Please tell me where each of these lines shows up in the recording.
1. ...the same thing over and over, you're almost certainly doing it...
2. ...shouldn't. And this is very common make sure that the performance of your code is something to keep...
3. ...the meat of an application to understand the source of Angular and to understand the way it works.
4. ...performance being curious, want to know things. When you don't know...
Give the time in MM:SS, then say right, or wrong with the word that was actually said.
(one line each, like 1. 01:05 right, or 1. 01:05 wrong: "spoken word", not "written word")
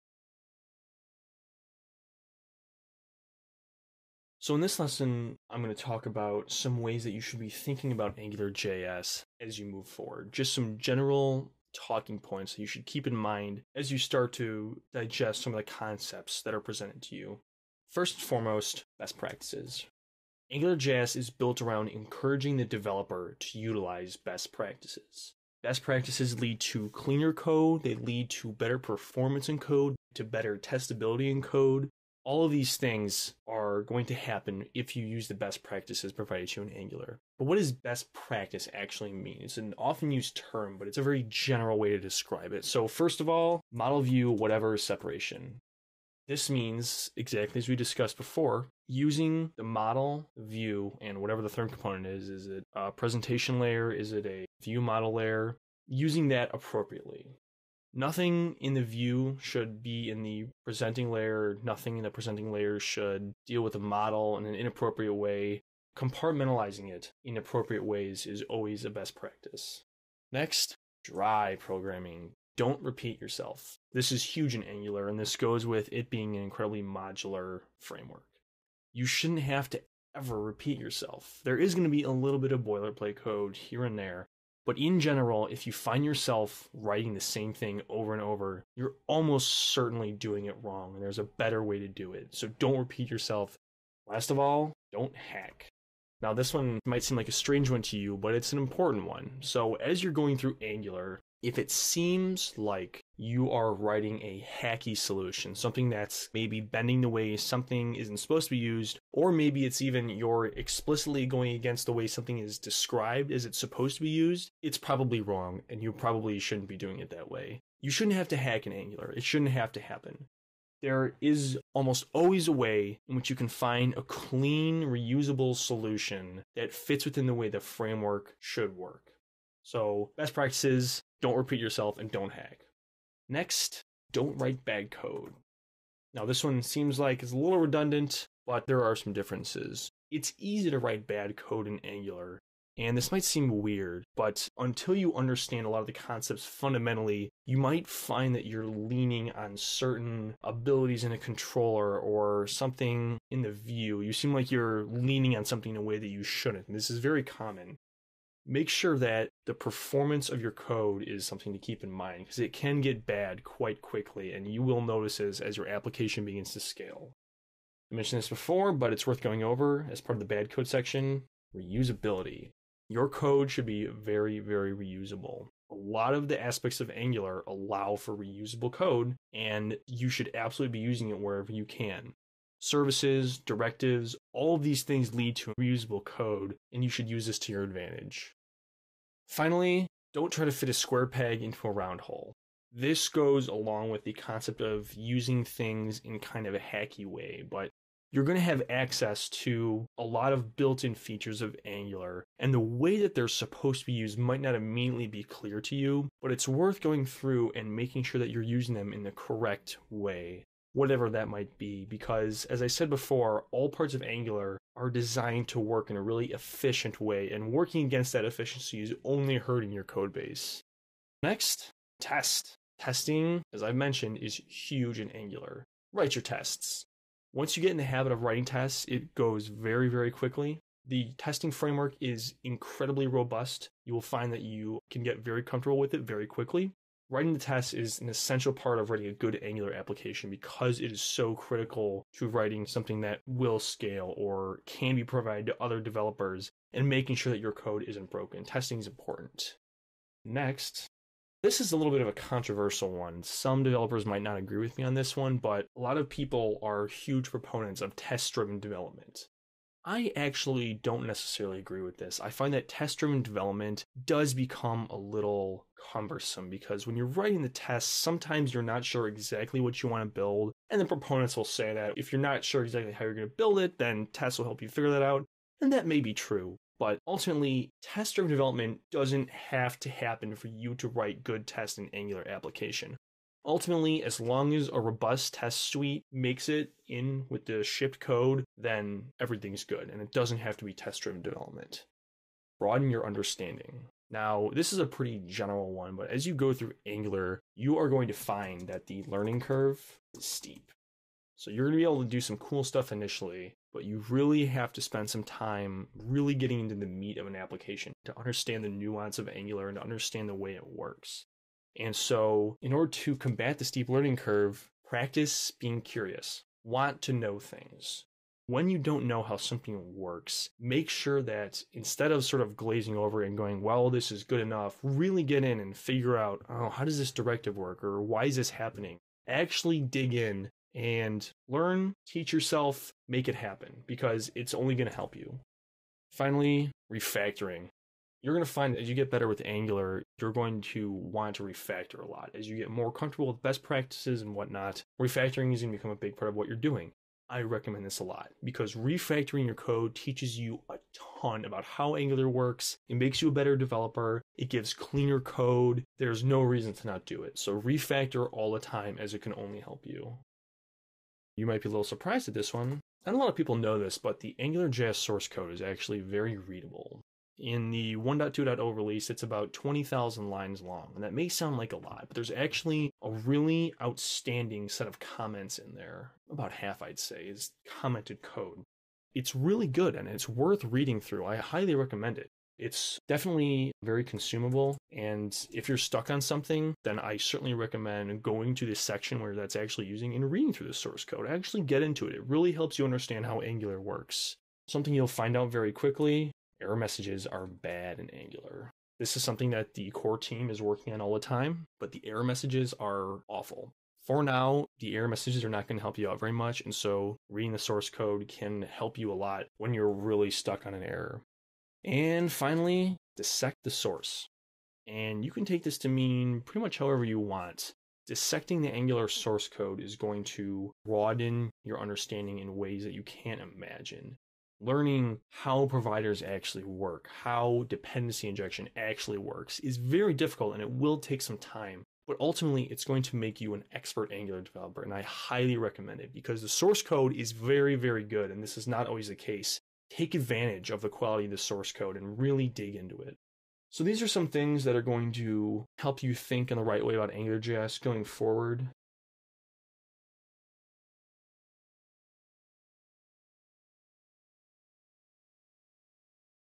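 1. 01:27 right
2. 02:36 right
3. 05:06 wrong: "nuance", not "source"
4. 05:14 wrong: "practice", not "performance".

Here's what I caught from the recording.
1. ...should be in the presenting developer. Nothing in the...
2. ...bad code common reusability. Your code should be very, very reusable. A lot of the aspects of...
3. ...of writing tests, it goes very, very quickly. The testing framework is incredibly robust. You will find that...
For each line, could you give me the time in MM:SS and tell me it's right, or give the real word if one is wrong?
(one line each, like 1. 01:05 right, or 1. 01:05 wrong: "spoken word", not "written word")
1. 00:59 wrong: "layer", not "developer"
2. 02:50 wrong: "section", not "common"
3. 03:48 right.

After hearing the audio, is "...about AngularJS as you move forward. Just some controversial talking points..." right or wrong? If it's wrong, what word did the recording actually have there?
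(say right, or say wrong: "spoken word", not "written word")
wrong: "general", not "controversial".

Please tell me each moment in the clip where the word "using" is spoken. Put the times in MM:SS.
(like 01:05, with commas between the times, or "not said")
00:48, 00:55, 03:00, 03:14, 03:28, 06:29.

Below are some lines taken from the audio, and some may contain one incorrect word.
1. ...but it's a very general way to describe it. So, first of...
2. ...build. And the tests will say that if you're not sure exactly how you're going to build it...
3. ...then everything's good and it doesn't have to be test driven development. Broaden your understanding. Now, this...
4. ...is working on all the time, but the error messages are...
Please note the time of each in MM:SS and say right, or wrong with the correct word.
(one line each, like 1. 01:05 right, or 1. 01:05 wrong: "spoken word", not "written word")
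1. 00:40 right
2. 04:30 wrong: "proponents", not "tests"
3. 04:48 right
4. 06:40 right.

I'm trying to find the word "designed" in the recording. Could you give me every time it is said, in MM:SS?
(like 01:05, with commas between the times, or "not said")
03:34.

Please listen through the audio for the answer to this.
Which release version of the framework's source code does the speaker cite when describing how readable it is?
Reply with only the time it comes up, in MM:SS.
06:07.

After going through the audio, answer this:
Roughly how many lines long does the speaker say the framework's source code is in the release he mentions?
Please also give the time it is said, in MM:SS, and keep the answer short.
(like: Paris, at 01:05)
20,000, at 06:09.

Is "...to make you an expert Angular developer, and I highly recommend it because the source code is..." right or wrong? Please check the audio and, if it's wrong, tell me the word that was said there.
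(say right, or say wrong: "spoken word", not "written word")
right.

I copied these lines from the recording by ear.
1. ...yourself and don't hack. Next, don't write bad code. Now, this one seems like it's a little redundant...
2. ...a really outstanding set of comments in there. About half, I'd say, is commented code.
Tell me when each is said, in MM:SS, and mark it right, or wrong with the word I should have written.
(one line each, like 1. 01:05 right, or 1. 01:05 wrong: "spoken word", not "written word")
1. 02:11 right
2. 06:13 right.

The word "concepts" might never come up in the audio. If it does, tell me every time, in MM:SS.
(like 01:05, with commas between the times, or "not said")
00:15, 02:25, 03:14.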